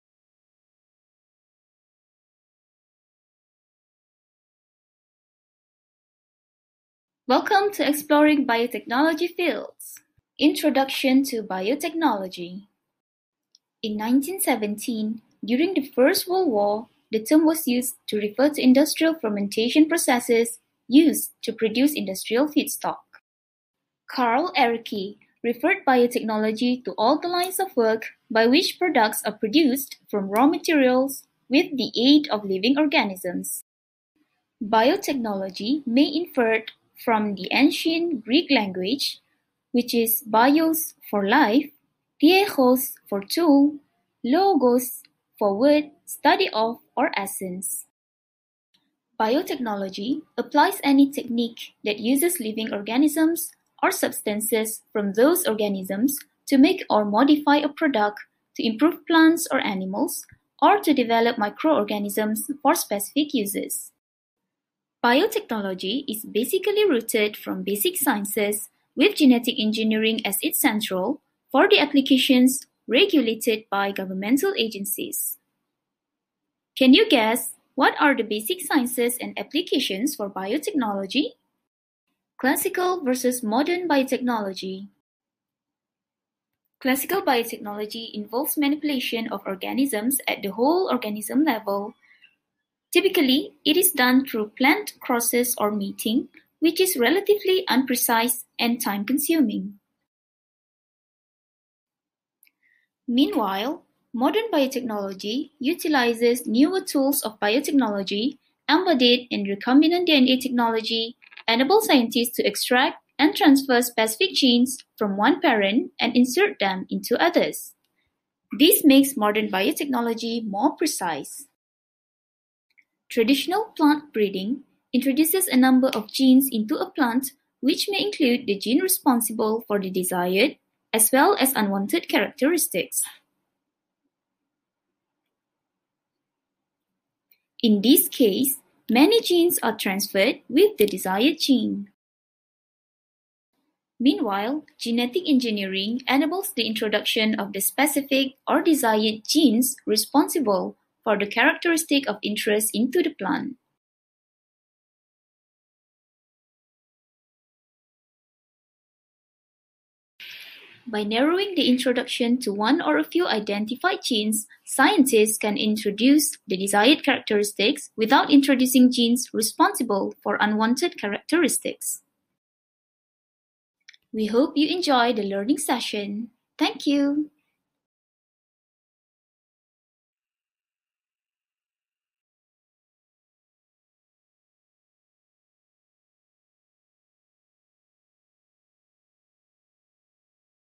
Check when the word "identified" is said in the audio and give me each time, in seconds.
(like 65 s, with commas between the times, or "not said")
163 s.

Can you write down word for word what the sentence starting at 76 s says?
Can you guess what are the basic sciences and applications for biotechnology?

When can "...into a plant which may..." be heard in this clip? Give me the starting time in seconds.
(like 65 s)
126 s.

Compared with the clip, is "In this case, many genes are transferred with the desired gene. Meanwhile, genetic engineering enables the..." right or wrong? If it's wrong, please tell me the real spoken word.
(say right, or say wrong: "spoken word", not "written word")
right.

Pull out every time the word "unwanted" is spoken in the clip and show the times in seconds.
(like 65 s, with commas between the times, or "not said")
131 s, 170 s.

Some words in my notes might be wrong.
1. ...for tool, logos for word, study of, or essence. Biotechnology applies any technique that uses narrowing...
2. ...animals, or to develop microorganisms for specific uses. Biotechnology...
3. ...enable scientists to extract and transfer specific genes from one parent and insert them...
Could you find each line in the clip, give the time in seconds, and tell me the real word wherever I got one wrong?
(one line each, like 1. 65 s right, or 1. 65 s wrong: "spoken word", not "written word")
1. 43 s wrong: "living", not "narrowing"
2. 59 s right
3. 111 s right.